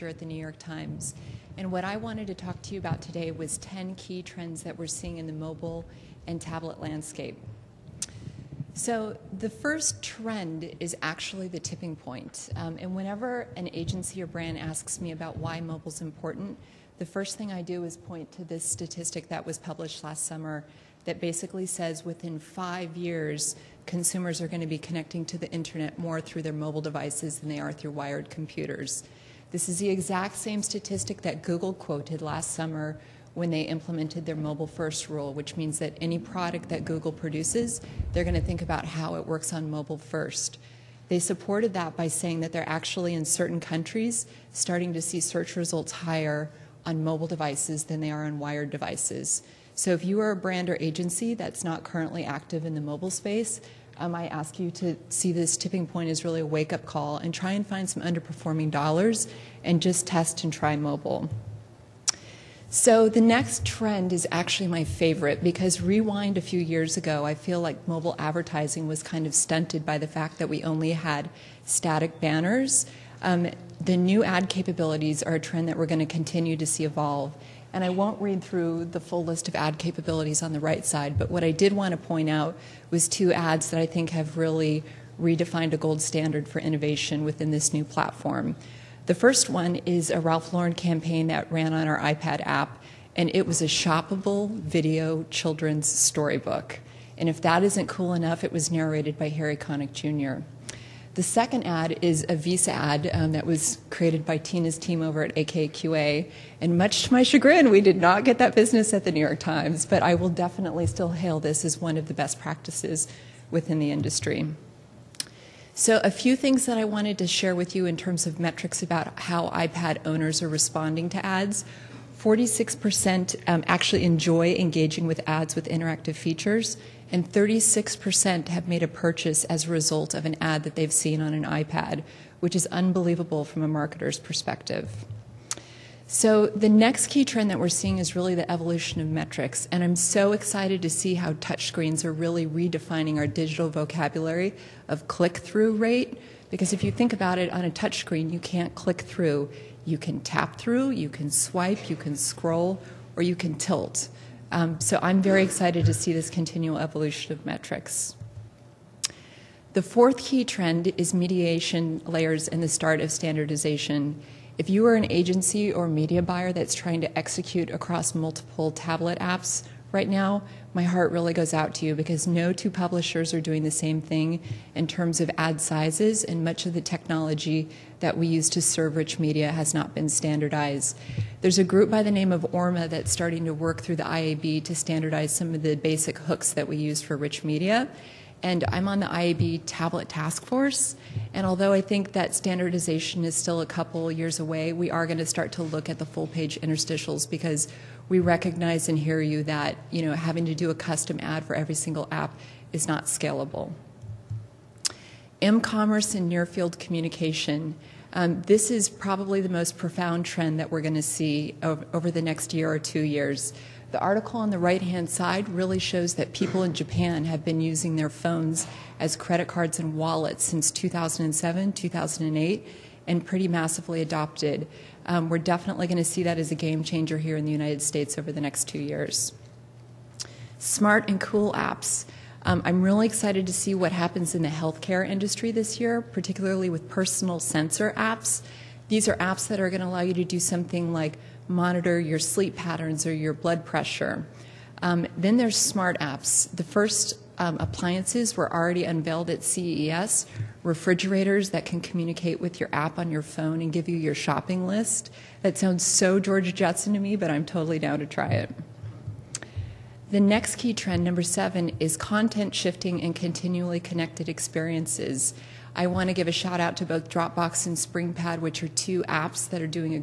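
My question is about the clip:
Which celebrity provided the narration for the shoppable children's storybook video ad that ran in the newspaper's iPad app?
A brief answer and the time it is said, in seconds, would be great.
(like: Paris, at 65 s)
Harry Connick Jr., at 99 s.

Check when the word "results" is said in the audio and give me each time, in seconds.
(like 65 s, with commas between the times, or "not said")
45 s, 129 s.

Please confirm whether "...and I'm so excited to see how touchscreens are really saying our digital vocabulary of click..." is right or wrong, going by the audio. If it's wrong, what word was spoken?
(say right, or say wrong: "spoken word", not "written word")
wrong: "redefining", not "saying".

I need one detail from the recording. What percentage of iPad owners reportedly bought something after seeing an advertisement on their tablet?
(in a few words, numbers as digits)
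36%.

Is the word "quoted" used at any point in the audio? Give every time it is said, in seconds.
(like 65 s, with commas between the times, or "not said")
31 s.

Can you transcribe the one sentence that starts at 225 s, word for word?
Um, we're definitely going to see that as a game changer here in the United States over the next two years.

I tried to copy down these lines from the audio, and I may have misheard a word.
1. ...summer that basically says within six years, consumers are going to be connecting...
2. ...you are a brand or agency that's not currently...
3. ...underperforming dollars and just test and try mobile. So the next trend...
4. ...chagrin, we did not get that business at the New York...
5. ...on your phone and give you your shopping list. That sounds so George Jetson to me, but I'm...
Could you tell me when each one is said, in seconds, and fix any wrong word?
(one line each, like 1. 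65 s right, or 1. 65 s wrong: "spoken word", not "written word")
1. 20 s wrong: "five", not "six"
2. 50 s right
3. 58 s right
4. 107 s right
5. 252 s right.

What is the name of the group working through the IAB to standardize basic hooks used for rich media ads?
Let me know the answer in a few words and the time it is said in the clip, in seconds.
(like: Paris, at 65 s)
ORMMA, at 182 s.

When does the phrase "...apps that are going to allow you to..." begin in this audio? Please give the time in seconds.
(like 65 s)
239 s.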